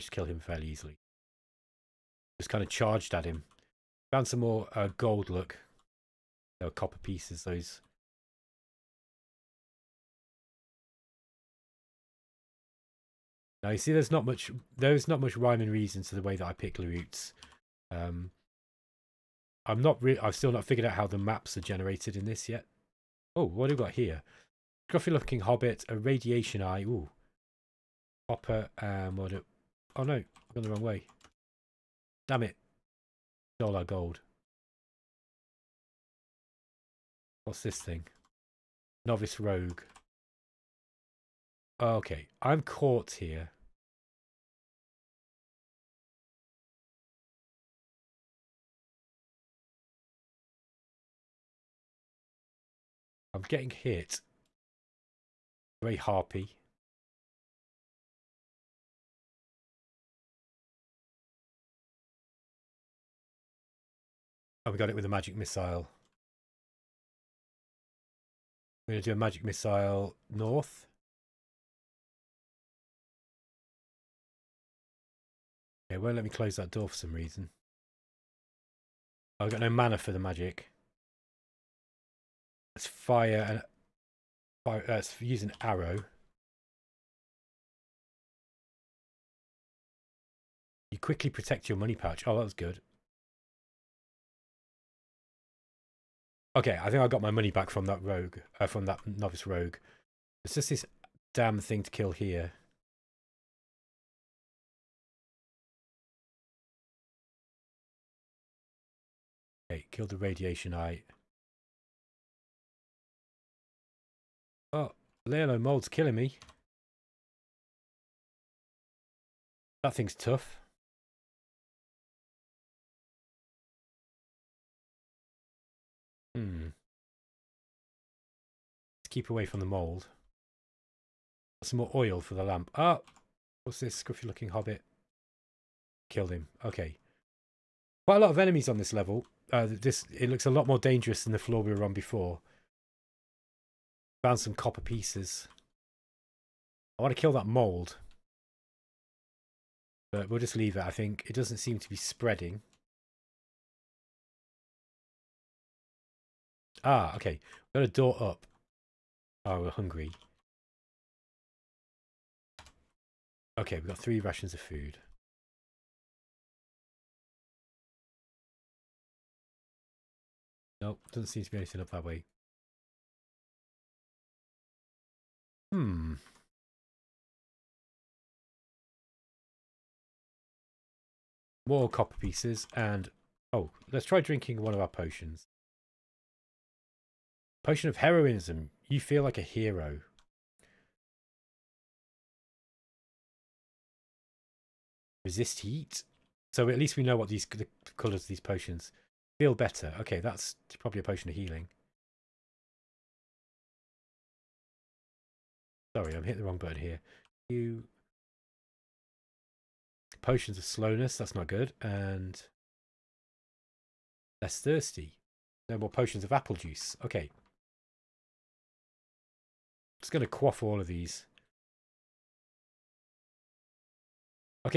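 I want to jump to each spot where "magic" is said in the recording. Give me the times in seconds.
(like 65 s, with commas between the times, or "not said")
65 s, 69 s, 80 s.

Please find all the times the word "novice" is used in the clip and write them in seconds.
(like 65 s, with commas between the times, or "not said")
39 s, 99 s.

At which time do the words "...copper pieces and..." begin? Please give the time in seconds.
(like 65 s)
181 s.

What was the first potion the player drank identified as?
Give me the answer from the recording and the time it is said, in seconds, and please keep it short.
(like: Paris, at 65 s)
Potion of heroism, at 187 s.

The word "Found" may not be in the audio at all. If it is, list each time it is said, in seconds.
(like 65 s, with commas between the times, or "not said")
4 s, 144 s.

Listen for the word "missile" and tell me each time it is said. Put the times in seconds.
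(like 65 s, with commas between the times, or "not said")
65 s, 69 s.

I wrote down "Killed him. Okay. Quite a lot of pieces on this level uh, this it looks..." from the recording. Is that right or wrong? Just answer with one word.
wrong.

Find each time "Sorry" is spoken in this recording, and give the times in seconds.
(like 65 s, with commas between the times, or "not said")
205 s.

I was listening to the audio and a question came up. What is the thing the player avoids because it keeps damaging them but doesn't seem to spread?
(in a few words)
Yellow mold.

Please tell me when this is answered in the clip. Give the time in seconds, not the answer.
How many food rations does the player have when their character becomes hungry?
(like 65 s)
163 s.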